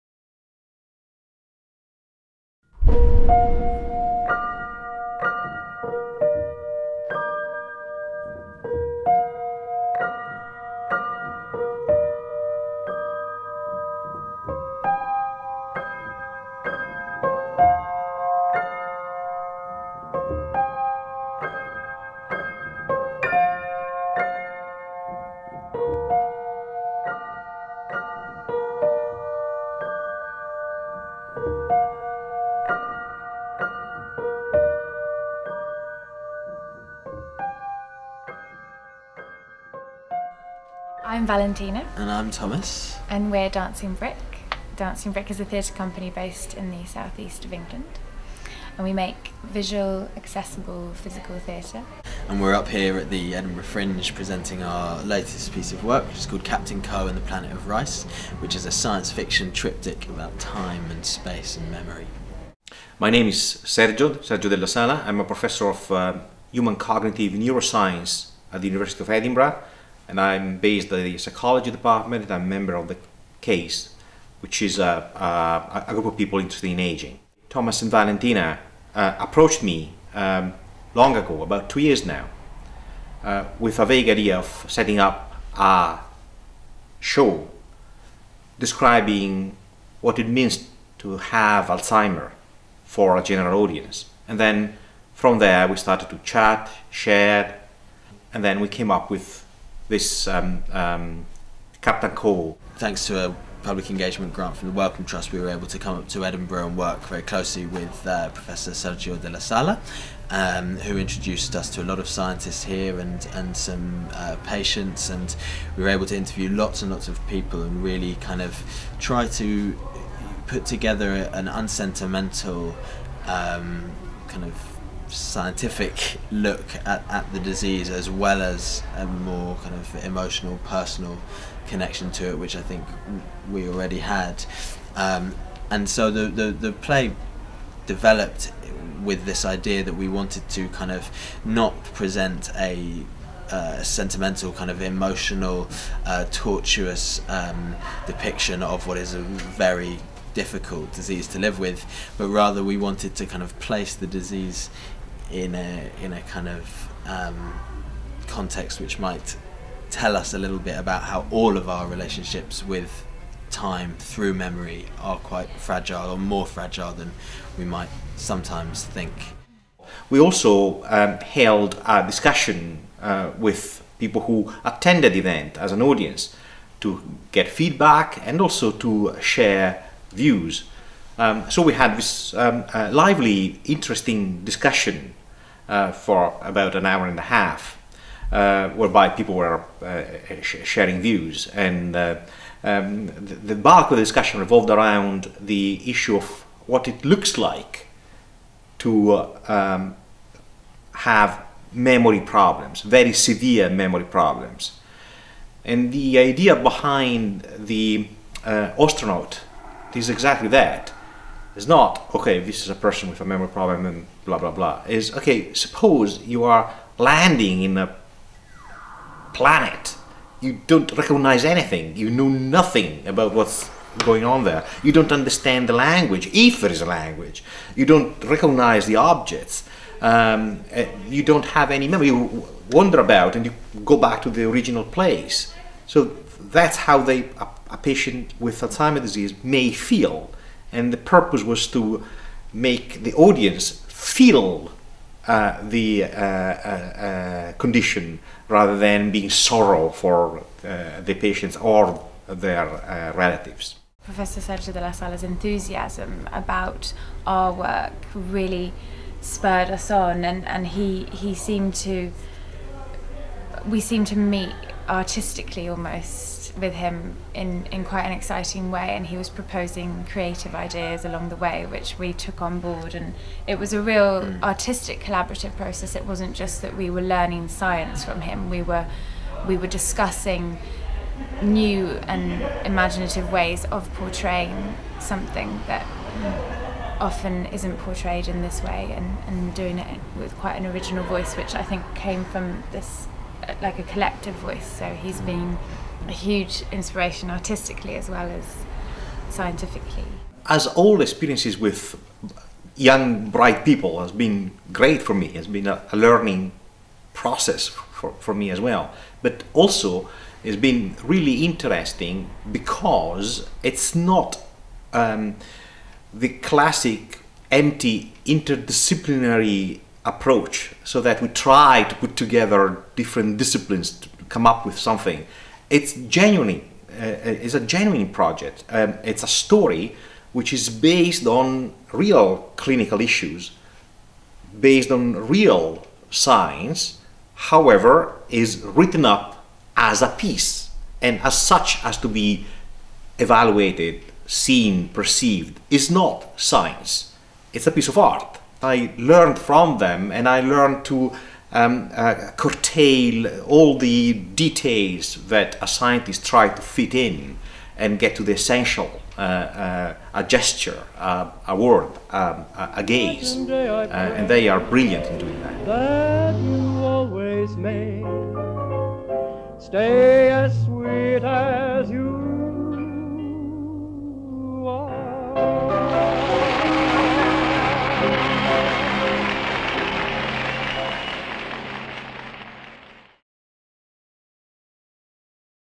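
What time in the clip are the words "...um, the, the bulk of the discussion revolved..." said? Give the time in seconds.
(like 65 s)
192 s.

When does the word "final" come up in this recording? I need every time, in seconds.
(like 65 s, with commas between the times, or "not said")
not said.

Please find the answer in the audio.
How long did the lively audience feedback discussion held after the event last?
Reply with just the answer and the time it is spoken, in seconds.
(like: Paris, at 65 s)
an hour and a half, at 186 s.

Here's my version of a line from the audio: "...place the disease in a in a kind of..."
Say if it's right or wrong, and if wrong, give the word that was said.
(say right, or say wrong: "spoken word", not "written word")
right.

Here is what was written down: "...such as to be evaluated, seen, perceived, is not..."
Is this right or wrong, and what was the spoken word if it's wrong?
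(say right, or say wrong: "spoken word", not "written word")
right.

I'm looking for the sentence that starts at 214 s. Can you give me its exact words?
Is okay, suppose you are landing in a planet.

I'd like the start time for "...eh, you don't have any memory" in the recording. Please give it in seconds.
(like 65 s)
230 s.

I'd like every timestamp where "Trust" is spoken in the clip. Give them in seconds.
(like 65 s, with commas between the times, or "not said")
105 s.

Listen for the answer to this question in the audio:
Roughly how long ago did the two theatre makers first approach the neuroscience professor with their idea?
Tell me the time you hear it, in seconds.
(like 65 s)
81 s.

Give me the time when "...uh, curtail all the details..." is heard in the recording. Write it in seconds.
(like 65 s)
351 s.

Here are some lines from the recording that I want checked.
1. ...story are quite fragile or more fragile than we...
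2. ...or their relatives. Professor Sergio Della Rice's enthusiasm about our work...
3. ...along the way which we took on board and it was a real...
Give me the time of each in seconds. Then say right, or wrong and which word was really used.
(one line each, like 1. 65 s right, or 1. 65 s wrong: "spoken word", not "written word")
1. 164 s wrong: "memory", not "story"
2. 251 s wrong: "Sala", not "Rice"
3. 271 s right.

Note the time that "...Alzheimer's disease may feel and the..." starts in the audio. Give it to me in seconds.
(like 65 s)
238 s.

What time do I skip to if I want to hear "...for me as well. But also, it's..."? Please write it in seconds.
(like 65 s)
308 s.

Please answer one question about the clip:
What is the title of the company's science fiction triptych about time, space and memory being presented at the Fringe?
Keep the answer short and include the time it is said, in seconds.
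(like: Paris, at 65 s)
Captain Ko and the Planet of Rice, at 56 s.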